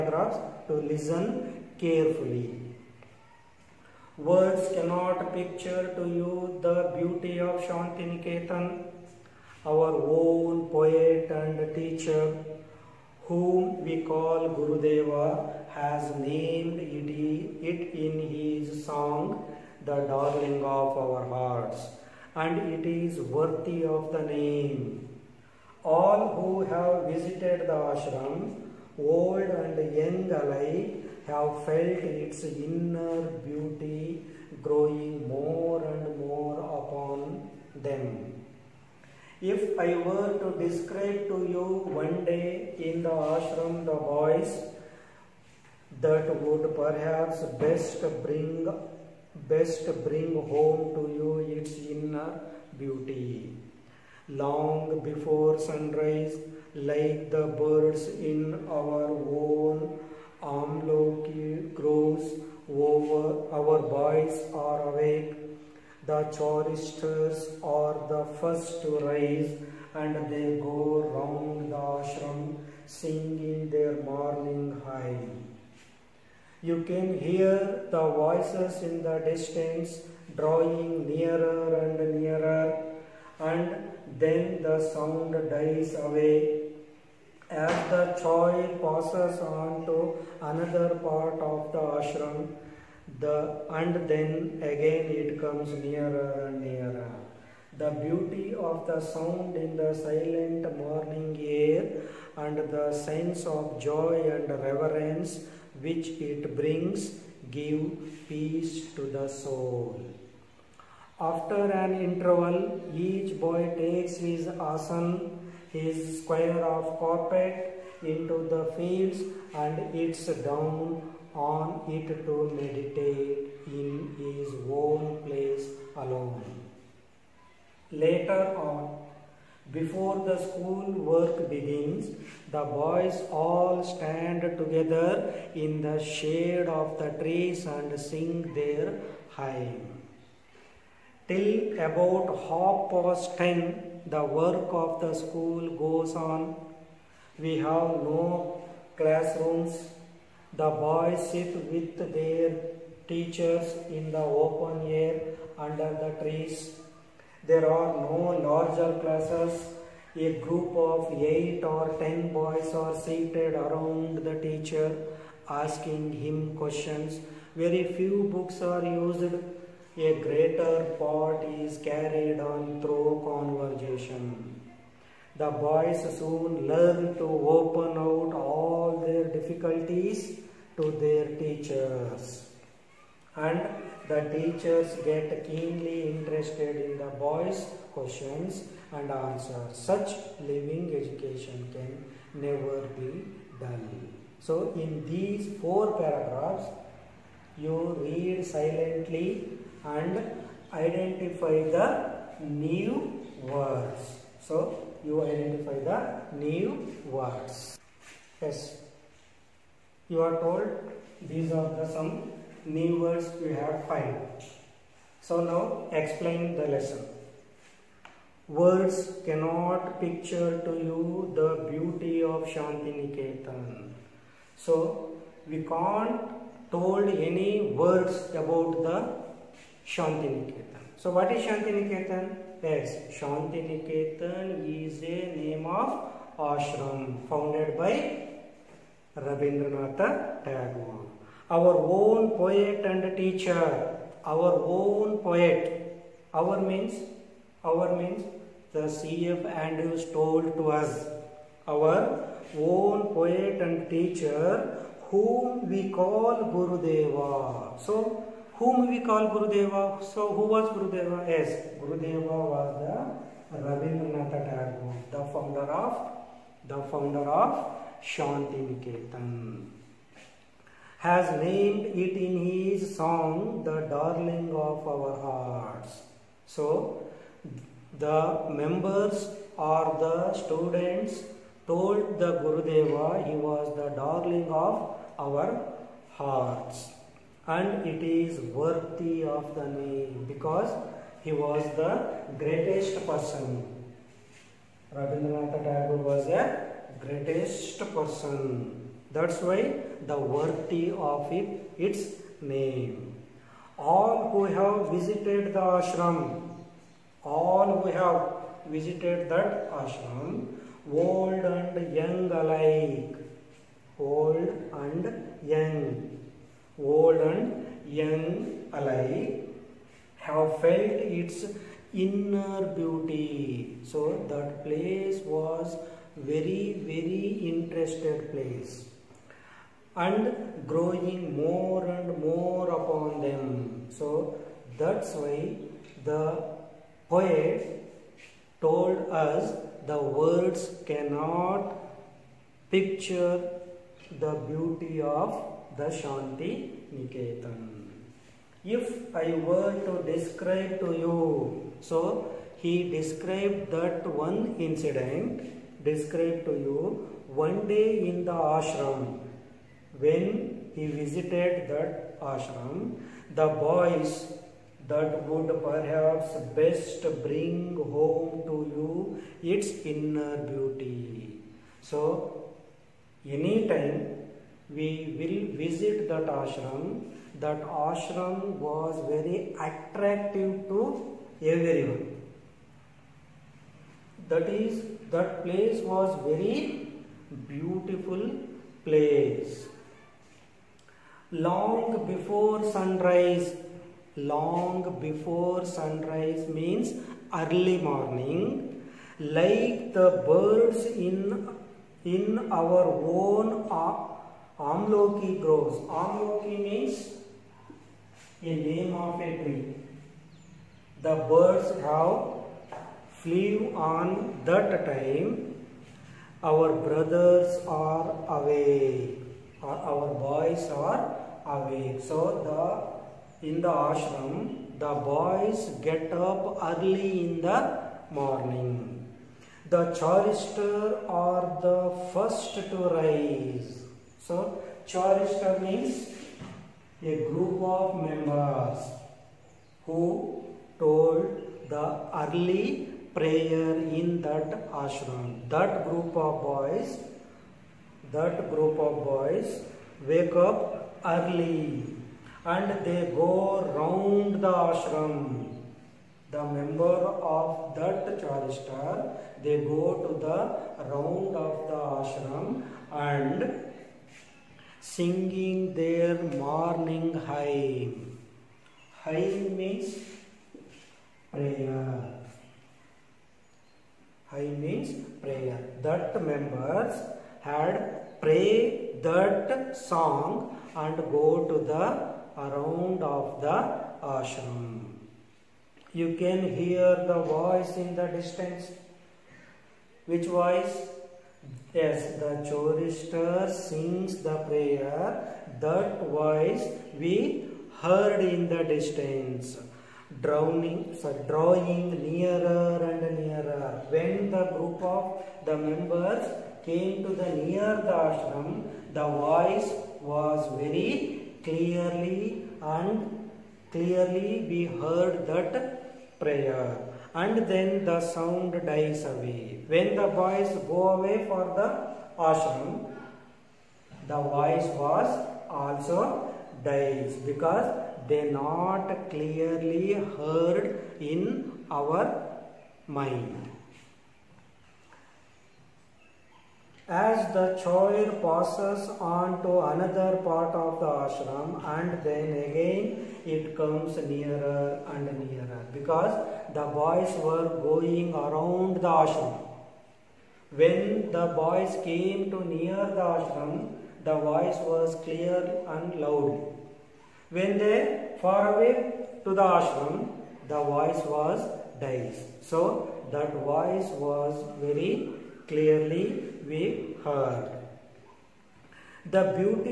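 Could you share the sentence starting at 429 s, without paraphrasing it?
The chorister are the first to rise.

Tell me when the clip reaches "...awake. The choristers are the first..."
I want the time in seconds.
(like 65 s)
64 s.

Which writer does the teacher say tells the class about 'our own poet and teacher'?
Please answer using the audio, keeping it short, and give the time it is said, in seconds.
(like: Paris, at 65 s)
C.F. Andrews, at 248 s.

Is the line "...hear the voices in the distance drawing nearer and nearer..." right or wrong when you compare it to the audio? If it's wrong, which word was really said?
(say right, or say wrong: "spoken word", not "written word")
right.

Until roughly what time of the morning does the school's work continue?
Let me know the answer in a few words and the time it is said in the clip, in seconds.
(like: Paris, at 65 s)
half past ten, at 142 s.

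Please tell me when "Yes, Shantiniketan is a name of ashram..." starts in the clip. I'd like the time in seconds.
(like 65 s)
232 s.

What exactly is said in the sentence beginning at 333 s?
So that's why the poet told us the words cannot picture the beauty of the Shanti Niketan.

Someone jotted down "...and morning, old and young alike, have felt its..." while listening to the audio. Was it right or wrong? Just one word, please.
wrong.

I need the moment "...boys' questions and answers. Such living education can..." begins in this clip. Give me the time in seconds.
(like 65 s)
187 s.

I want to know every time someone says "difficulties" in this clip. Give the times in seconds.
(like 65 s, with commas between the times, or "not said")
179 s.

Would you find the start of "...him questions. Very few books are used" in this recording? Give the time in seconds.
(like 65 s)
166 s.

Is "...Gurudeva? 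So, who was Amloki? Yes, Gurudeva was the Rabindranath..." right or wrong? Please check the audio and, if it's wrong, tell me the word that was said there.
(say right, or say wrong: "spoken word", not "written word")
wrong: "Gurudeva", not "Amloki".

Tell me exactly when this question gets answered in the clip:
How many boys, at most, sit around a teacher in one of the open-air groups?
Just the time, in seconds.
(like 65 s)
161 s.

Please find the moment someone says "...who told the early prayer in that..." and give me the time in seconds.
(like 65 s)
439 s.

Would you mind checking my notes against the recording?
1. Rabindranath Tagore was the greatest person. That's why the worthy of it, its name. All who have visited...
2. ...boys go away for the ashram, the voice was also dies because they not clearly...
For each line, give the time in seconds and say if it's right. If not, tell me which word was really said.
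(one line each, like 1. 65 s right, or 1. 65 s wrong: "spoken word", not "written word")
1. 294 s right
2. 520 s right.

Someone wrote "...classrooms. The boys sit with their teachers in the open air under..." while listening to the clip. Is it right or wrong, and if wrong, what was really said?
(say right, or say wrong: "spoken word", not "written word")
right.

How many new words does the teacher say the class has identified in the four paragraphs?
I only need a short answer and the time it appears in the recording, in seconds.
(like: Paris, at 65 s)
5, at 213 s.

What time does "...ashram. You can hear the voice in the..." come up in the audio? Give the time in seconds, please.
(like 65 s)
484 s.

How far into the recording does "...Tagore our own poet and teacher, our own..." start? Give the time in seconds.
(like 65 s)
240 s.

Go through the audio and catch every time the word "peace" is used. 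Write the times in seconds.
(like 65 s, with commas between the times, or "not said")
108 s.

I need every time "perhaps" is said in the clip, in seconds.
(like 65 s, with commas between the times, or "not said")
46 s, 365 s.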